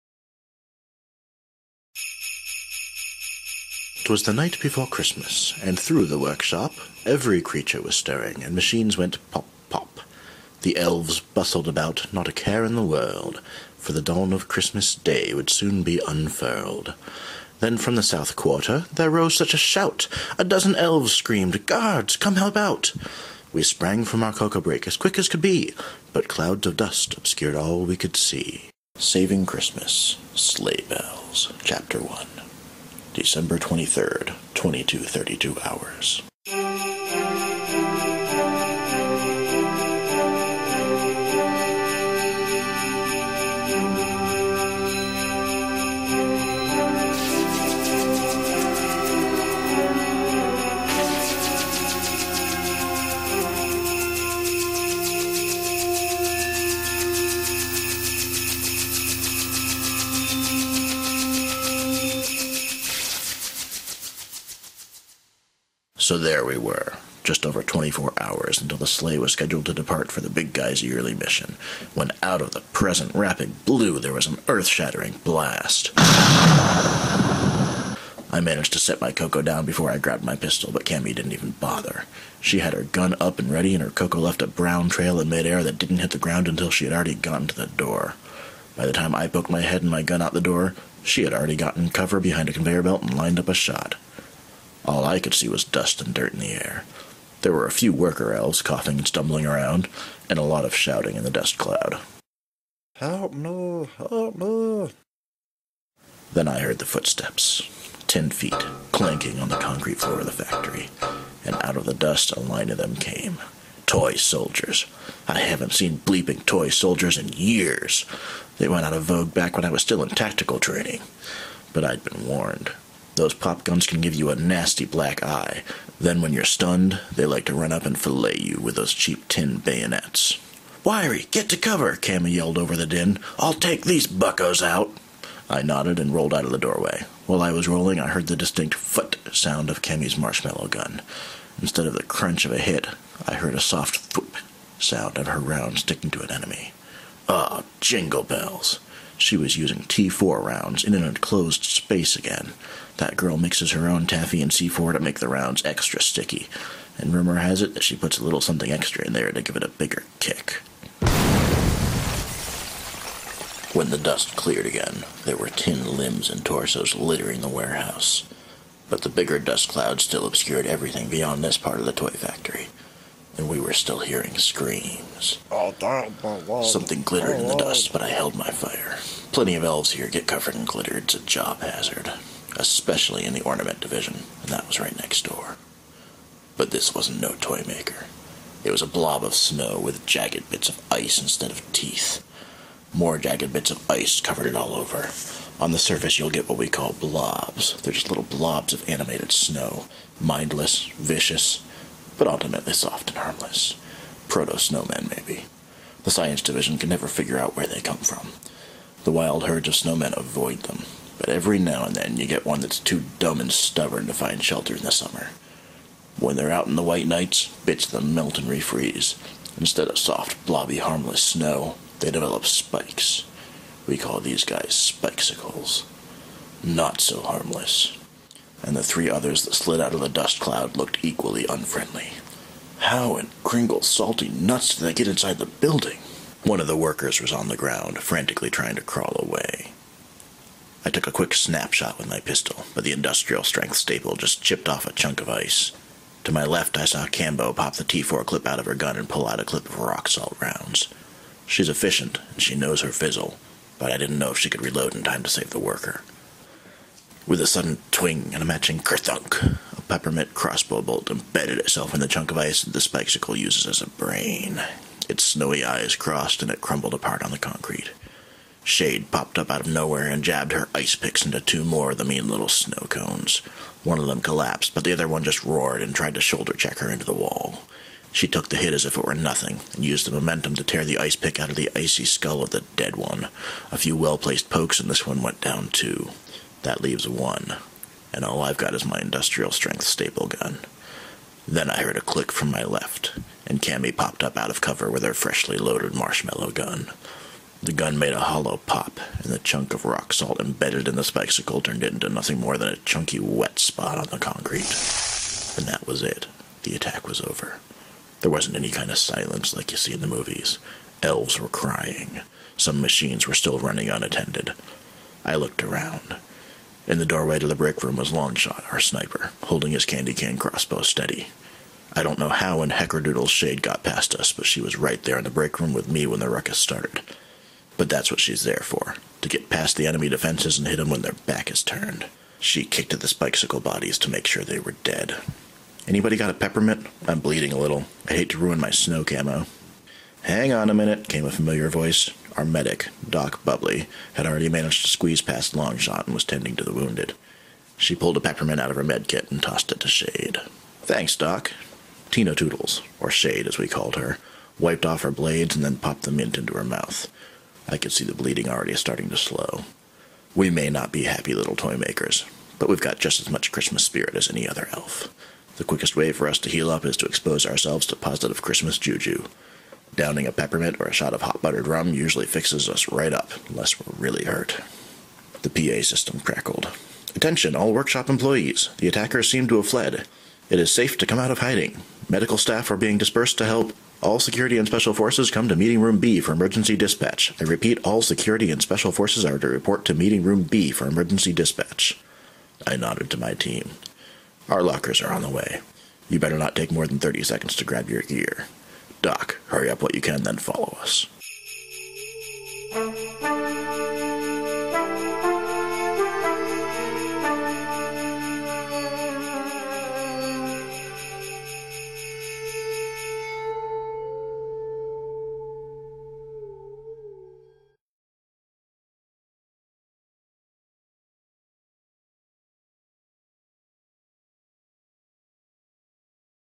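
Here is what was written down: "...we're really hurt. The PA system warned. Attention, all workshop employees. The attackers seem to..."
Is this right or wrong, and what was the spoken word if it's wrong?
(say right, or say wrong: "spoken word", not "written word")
wrong: "crackled", not "warned".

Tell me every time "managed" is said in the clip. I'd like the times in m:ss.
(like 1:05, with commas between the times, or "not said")
1:18, 5:44.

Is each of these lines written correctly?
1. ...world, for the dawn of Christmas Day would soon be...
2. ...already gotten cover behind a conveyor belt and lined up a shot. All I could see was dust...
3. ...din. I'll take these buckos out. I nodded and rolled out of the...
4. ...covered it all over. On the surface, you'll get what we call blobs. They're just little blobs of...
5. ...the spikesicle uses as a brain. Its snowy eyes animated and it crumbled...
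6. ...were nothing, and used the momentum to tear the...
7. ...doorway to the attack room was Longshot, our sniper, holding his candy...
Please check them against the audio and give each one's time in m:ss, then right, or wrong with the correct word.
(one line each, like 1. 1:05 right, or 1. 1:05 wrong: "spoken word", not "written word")
1. 0:12 right
2. 1:31 right
3. 2:12 right
4. 3:14 right
5. 4:22 wrong: "crossed", not "animated"
6. 4:39 right
7. 5:17 wrong: "brick", not "attack".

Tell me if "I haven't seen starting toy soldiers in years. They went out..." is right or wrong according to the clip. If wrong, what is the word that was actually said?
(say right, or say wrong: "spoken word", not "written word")
wrong: "bleeping", not "starting".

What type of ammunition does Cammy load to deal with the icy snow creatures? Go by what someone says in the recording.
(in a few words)
rock salt rounds.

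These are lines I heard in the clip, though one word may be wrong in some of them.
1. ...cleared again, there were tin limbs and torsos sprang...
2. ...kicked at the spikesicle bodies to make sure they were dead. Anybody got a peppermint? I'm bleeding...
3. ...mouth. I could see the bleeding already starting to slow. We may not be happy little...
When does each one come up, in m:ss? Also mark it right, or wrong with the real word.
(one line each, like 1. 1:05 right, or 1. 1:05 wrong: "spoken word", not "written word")
1. 2:44 wrong: "littering", not "sprang"
2. 5:32 right
3. 5:56 right.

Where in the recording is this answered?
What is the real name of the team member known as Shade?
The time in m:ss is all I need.
5:52.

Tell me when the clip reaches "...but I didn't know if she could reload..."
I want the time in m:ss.
4:13.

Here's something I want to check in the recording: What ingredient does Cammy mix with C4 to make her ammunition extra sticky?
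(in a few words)
taffy.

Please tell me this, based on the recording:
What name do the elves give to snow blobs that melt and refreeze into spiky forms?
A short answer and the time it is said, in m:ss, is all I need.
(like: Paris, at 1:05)
spikesicles, at 3:44.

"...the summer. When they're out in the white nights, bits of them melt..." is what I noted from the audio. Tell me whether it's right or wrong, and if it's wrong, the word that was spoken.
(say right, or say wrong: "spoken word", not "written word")
right.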